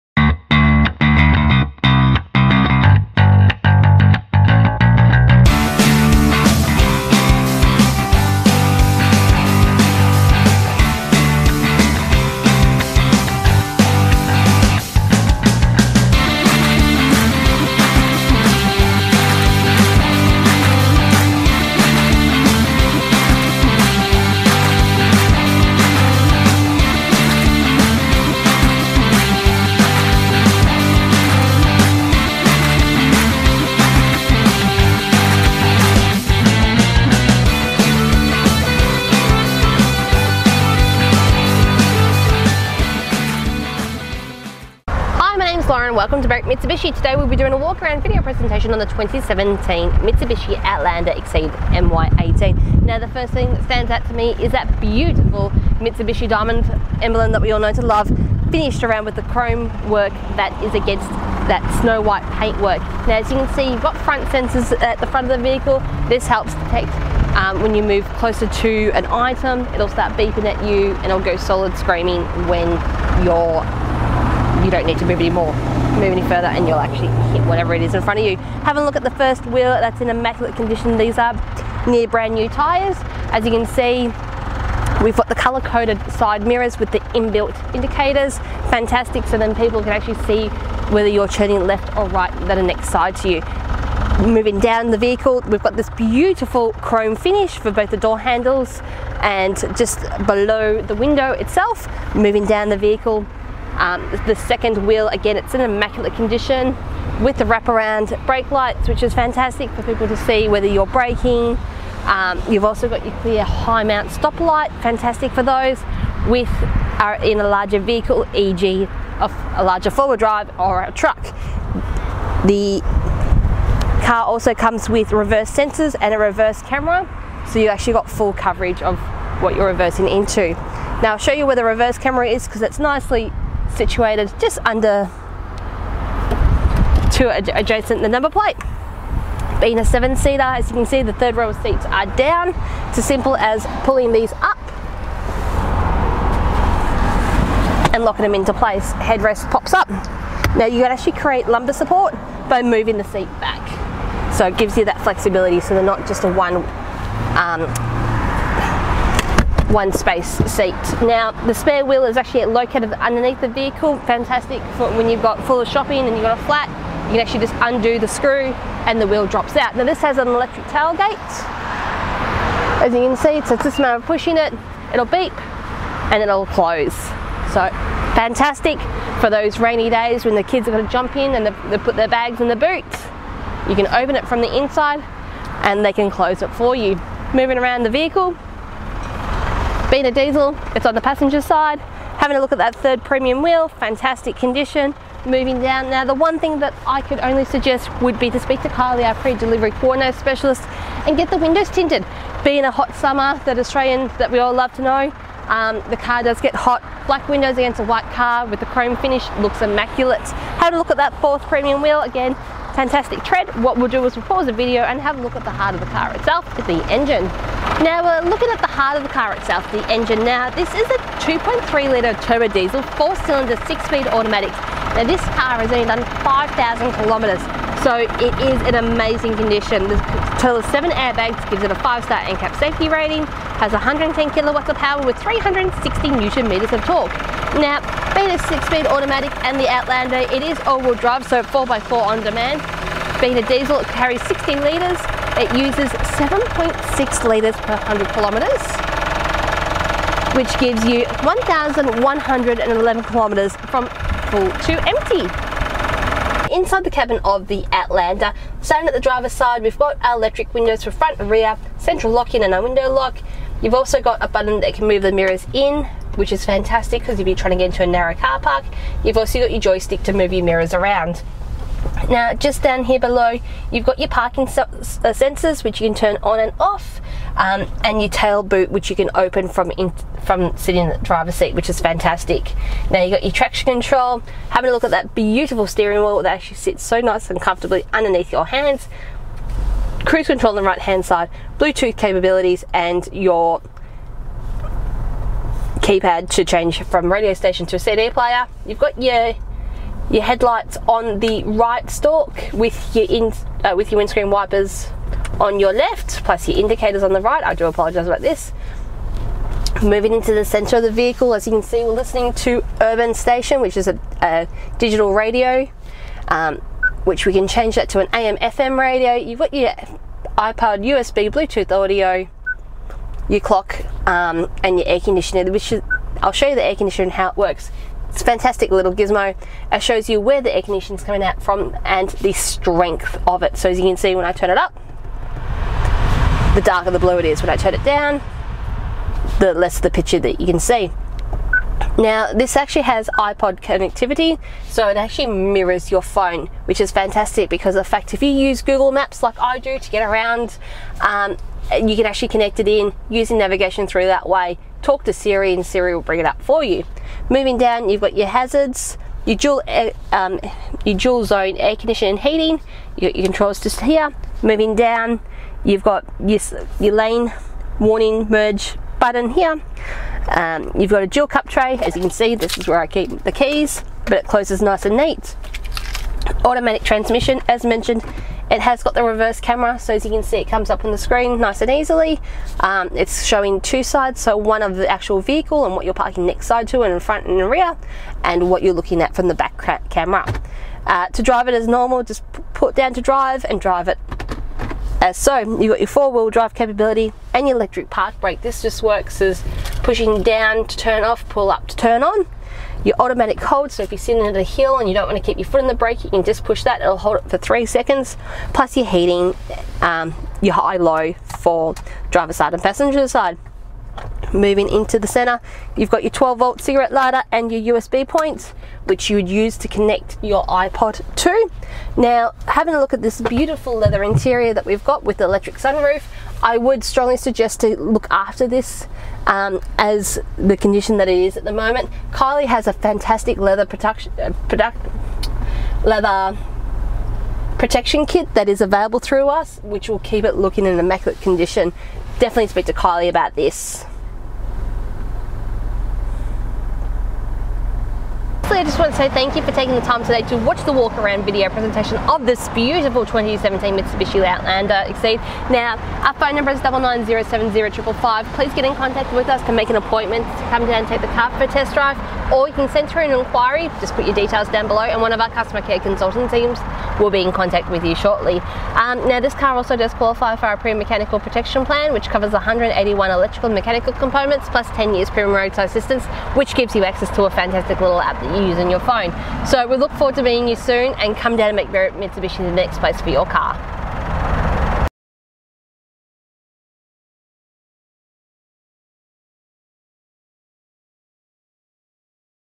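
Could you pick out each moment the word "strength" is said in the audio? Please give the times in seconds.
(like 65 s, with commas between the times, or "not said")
332 s.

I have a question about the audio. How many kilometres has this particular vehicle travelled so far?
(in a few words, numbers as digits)
5,000 kilometres.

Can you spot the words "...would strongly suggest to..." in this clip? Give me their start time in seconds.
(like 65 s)
426 s.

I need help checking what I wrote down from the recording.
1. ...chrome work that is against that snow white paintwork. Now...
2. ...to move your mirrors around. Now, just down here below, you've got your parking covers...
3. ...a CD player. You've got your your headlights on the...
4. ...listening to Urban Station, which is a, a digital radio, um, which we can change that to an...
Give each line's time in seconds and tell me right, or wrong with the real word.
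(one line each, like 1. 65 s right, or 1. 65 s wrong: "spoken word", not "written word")
1. 59 s right
2. 270 s wrong: "sensors", not "covers"
3. 297 s right
4. 311 s right.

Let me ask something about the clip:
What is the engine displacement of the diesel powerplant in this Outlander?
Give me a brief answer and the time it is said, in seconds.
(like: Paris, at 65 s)
2.3 litre, at 221 s.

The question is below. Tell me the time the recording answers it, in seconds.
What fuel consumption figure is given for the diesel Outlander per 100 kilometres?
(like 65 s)
246 s.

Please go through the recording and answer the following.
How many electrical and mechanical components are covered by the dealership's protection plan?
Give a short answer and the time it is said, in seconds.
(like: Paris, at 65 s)
181, at 472 s.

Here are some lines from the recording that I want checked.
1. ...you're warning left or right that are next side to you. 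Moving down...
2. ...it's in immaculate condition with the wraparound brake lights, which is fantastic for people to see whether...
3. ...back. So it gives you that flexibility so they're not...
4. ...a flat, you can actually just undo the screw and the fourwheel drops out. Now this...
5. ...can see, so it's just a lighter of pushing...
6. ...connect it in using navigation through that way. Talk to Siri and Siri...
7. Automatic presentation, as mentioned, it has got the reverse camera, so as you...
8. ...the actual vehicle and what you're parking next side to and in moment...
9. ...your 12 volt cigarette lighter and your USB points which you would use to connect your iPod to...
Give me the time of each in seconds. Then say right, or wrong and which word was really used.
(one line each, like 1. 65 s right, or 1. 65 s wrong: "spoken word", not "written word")
1. 91 s wrong: "turning", not "warning"
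2. 105 s right
3. 153 s right
4. 166 s wrong: "wheel", not "fourwheel"
5. 172 s wrong: "matter", not "lighter"
6. 352 s right
7. 376 s wrong: "transmission", not "presentation"
8. 384 s wrong: "front", not "moment"
9. 416 s right.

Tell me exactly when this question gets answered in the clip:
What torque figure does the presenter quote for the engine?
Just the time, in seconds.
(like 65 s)
235 s.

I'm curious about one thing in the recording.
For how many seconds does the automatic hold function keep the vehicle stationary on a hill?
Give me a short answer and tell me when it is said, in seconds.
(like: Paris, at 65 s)
3 seconds, at 407 s.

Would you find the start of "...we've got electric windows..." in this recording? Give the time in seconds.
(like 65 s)
259 s.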